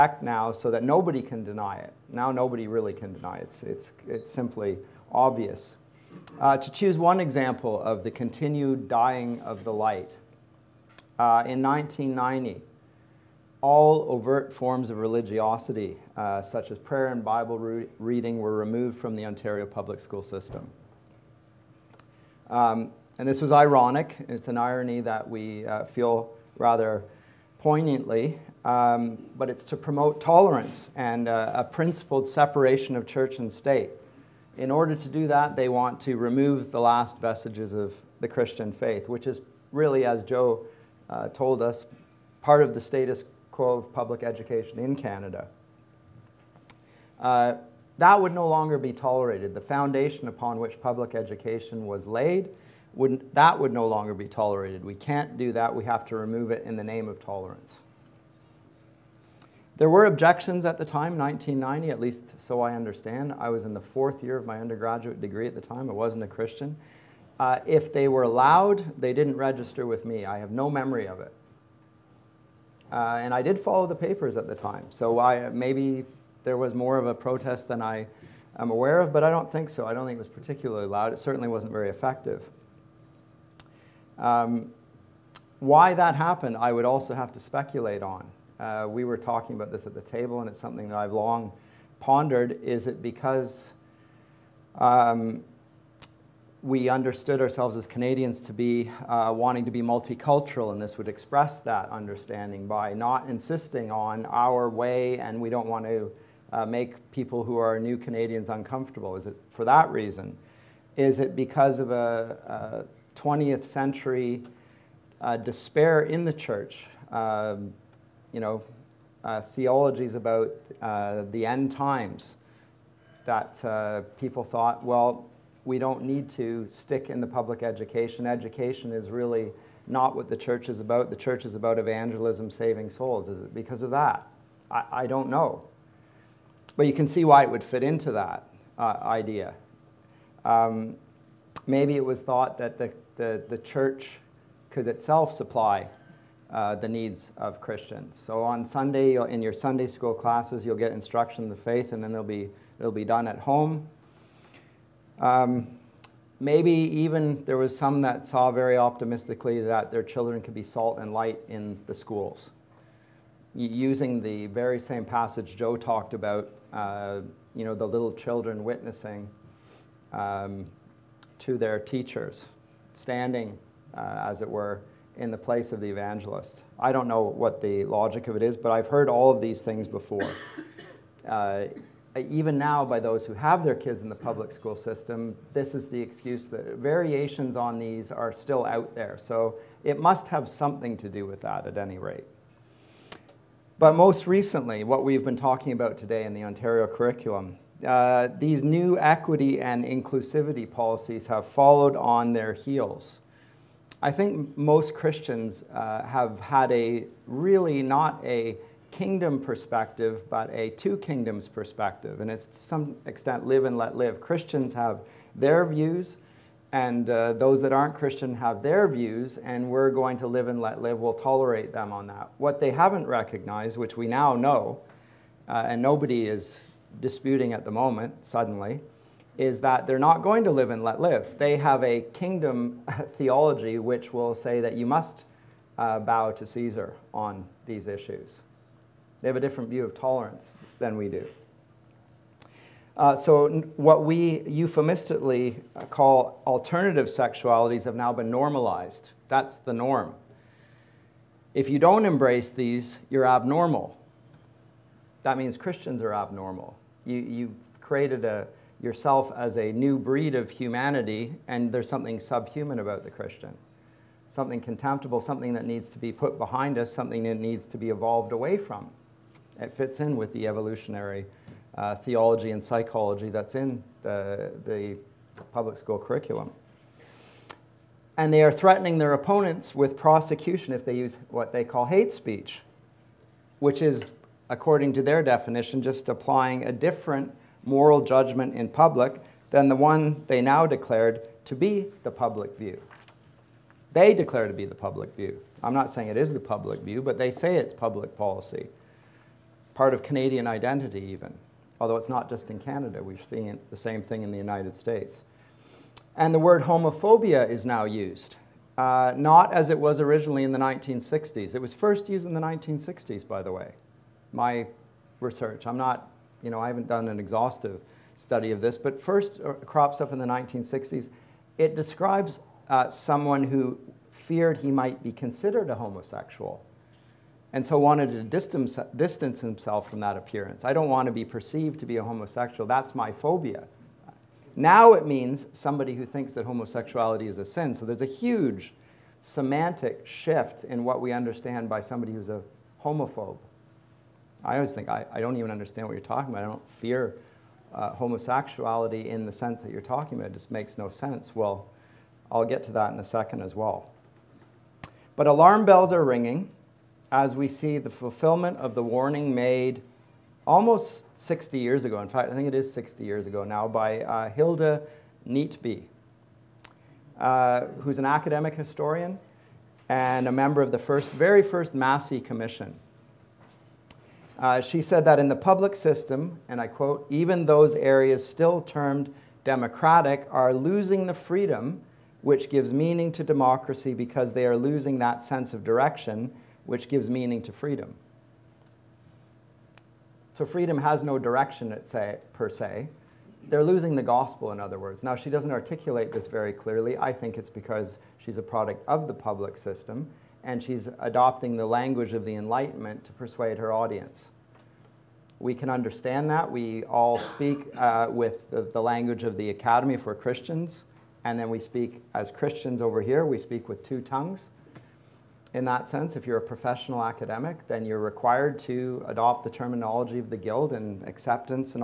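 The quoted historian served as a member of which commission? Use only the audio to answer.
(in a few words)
Massey Commission.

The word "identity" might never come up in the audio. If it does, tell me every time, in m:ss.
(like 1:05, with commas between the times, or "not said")
5:00.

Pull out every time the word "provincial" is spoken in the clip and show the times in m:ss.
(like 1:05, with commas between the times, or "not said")
not said.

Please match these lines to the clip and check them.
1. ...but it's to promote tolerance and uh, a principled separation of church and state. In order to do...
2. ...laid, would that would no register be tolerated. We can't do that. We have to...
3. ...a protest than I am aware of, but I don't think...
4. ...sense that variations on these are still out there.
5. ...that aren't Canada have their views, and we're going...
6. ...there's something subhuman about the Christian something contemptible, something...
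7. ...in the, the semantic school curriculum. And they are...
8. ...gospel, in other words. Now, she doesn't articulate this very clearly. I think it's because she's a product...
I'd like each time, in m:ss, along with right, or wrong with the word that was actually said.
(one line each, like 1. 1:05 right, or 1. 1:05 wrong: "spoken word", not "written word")
1. 0:29 right
2. 0:52 wrong: "longer", not "register"
3. 1:17 right
4. 3:05 wrong: "excuse", not "sense"
5. 3:37 wrong: "Christian", not "Canada"
6. 4:21 right
7. 4:33 wrong: "public", not "semantic"
8. 6:34 right.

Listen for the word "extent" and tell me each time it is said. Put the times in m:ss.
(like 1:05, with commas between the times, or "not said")
3:33.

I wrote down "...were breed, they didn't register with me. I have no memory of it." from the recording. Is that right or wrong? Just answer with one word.
wrong.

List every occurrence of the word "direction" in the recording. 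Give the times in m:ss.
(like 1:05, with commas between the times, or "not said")
6:25, 6:31.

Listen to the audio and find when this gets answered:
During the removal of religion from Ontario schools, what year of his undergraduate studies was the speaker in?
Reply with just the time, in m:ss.
1:03.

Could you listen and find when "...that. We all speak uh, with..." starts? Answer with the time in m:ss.
6:46.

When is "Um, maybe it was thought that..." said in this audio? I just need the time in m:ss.
2:20.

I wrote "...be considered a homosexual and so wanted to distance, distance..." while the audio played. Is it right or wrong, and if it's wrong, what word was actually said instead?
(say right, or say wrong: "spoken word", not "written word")
right.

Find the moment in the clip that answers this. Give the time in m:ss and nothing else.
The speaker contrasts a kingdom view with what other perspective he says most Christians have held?
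3:30.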